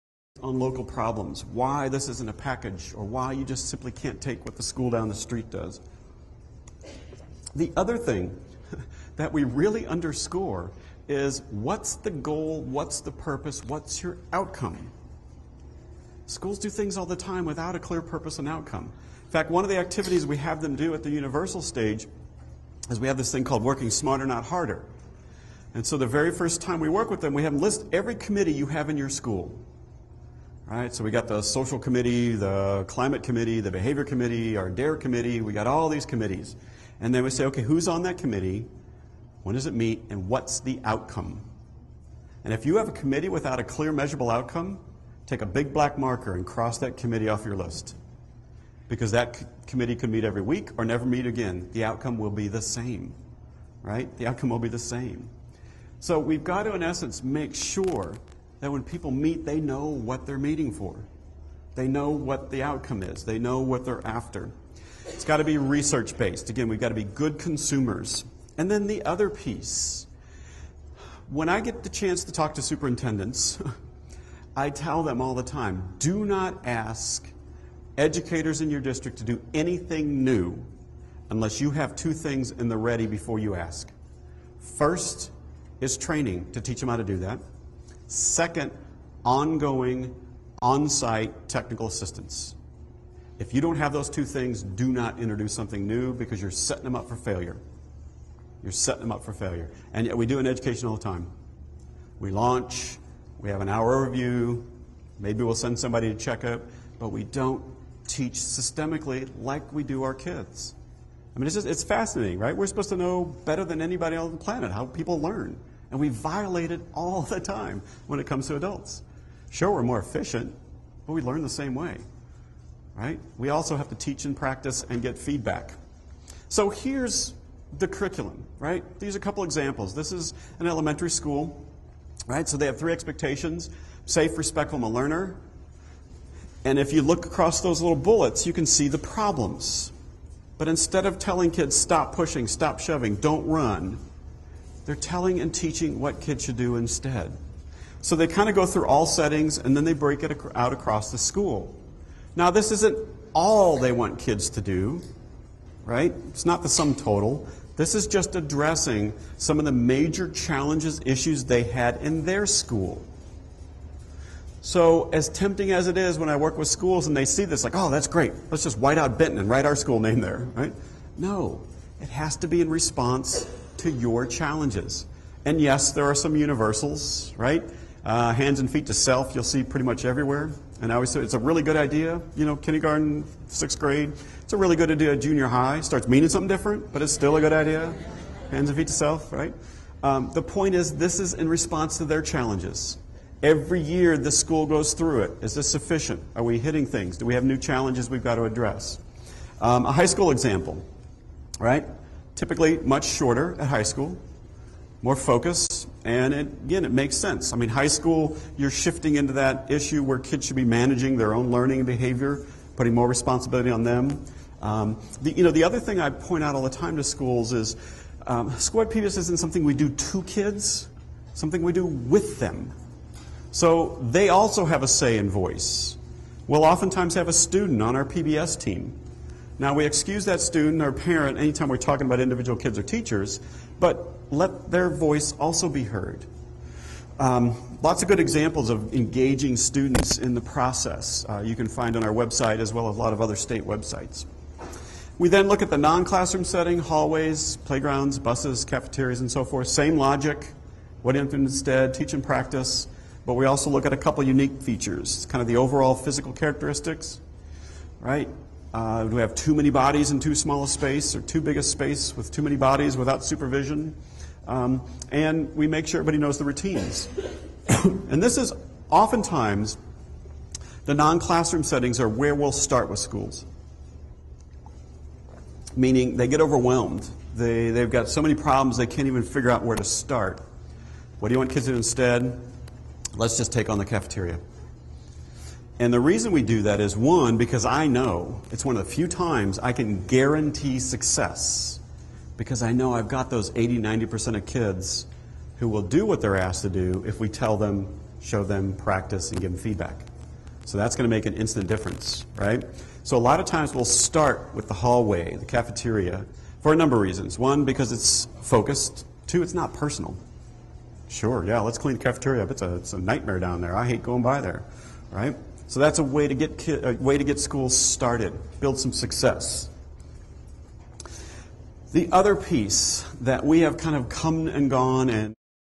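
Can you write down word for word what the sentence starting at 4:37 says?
They, they've got so many problems they can't even figure out where to start.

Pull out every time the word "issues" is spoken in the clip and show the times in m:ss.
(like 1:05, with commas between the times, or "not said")
2:41, 3:29.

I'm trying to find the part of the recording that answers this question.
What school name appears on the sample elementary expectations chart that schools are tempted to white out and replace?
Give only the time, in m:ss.
2:49.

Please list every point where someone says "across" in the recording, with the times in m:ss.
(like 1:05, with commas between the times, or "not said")
2:17, 2:30.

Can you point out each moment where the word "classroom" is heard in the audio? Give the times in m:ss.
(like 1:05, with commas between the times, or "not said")
4:05, 4:31.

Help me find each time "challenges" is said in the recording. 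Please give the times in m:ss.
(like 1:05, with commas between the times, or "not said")
2:40, 2:54, 3:12, 3:17.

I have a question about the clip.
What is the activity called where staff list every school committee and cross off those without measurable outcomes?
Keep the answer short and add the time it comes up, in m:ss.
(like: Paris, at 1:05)
working smarter, not harder, at 0:23.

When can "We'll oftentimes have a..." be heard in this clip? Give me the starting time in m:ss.
3:46.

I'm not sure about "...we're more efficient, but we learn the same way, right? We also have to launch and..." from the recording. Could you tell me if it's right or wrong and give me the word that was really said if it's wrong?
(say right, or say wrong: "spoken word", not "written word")
wrong: "teach", not "launch".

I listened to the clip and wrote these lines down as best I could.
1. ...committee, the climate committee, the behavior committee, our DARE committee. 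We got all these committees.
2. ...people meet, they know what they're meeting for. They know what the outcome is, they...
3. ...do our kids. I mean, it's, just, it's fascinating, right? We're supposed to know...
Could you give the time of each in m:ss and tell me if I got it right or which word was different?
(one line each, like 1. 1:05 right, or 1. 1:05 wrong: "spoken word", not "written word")
1. 0:31 right
2. 0:58 right
3. 1:49 right.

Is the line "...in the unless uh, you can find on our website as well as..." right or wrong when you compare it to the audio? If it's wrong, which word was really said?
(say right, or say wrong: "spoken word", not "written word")
wrong: "process", not "unless".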